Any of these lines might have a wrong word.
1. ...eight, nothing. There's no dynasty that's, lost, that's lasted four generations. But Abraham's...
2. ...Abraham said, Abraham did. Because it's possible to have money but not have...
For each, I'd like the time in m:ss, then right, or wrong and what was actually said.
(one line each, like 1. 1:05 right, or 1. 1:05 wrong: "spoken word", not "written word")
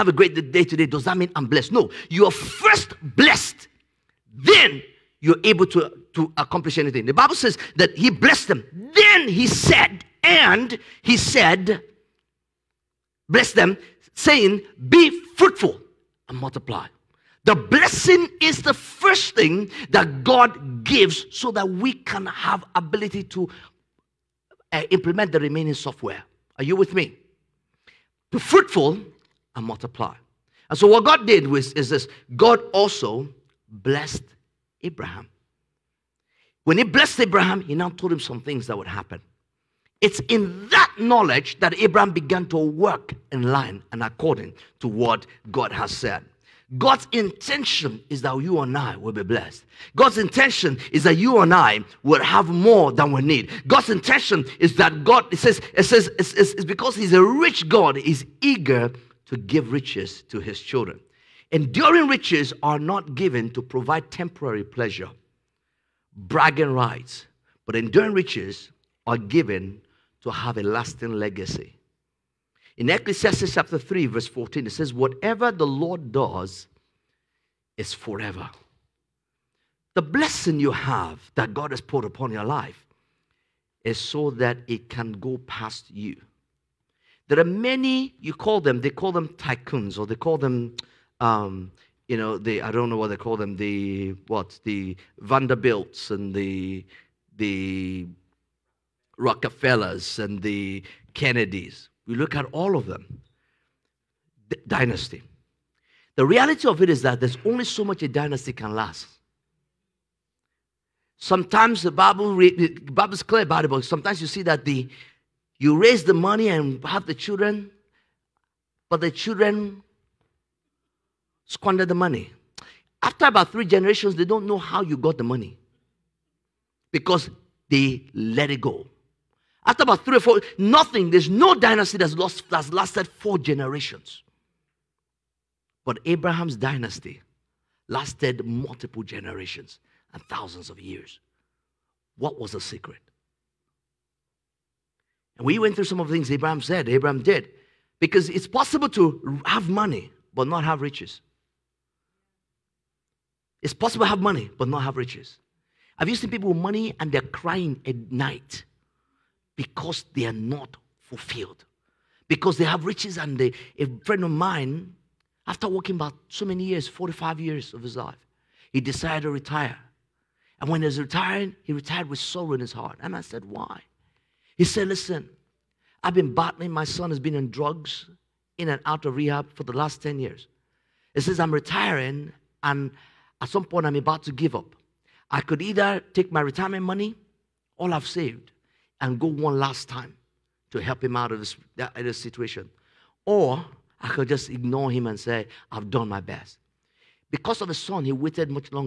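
1. 2:10 wrong: "four", not "eight"
2. 2:26 right.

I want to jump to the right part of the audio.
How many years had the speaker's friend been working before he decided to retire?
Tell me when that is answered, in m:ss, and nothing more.
2:46.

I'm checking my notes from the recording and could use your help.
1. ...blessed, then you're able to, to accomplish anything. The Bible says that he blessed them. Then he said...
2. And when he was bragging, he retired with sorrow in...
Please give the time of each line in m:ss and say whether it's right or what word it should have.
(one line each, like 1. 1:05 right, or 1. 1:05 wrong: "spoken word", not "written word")
1. 0:03 right
2. 2:50 wrong: "retiring", not "bragging".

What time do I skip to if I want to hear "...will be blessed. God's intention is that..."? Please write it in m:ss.
0:48.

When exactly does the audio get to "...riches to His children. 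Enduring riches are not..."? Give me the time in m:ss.
0:59.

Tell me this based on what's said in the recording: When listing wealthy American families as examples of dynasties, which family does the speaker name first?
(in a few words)
Vanderbilts.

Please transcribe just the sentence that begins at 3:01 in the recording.
He says, I'm retiring, and at some point, I'm about to give up.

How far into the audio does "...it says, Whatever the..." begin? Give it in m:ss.
1:14.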